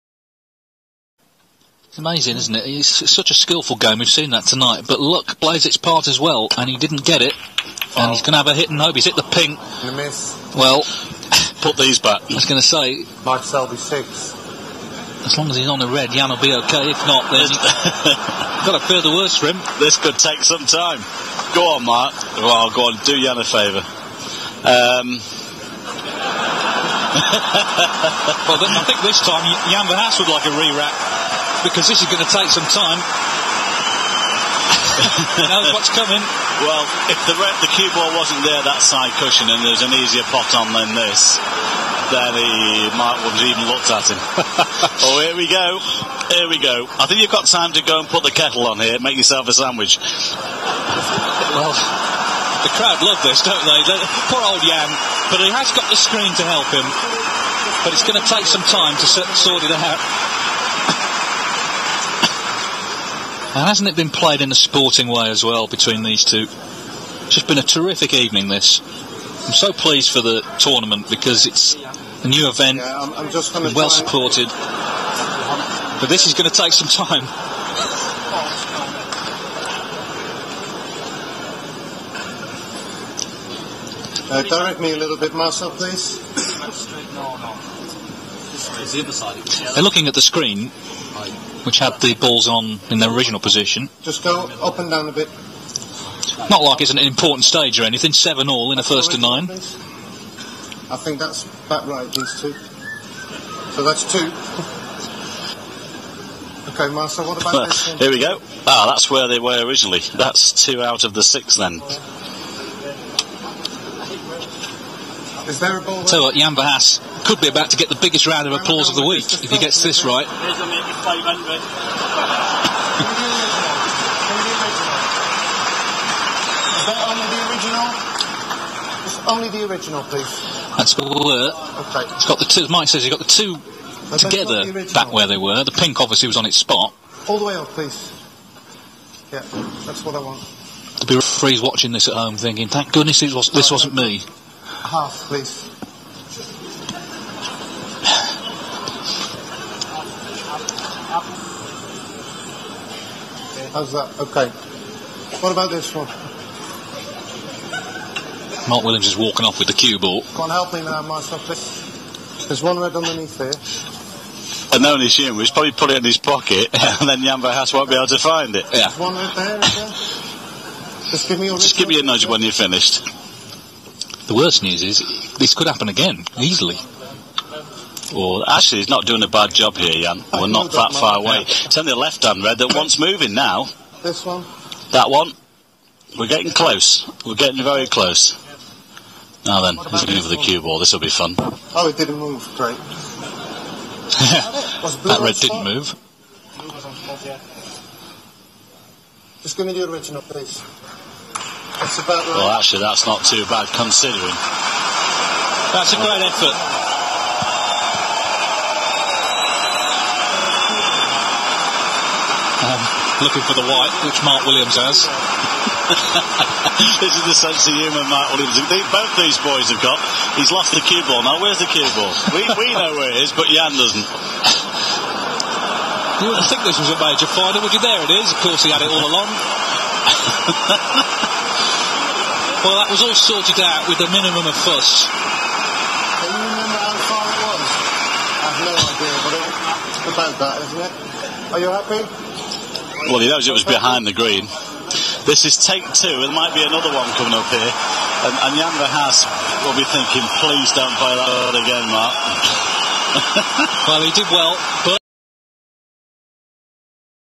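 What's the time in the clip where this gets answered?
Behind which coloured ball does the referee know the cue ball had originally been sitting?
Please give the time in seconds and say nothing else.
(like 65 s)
244 s.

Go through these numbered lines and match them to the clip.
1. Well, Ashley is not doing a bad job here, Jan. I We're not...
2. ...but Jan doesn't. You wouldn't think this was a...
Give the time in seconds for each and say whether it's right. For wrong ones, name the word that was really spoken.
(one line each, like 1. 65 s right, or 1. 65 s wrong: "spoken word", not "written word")
1. 178 s right
2. 223 s right.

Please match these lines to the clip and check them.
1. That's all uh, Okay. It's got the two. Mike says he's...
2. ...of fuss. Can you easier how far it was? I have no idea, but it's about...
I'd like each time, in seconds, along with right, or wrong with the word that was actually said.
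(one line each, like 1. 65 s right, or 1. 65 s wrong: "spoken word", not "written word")
1. 130 s right
2. 234 s wrong: "remember", not "easier".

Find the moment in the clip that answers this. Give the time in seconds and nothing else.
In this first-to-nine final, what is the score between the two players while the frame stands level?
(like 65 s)
98 s.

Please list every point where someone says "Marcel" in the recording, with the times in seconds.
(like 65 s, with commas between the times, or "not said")
85 s, 106 s.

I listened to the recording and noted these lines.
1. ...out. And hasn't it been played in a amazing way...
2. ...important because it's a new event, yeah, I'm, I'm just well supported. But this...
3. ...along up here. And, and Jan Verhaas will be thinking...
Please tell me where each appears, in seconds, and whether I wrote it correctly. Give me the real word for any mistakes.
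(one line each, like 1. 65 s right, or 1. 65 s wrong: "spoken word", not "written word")
1. 59 s wrong: "sporting", not "amazing"
2. 70 s wrong: "tournament", not "important"
3. 247 s wrong: "coming", not "along".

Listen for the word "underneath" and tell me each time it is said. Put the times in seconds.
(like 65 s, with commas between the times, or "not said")
162 s.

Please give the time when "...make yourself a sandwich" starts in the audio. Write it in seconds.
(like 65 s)
48 s.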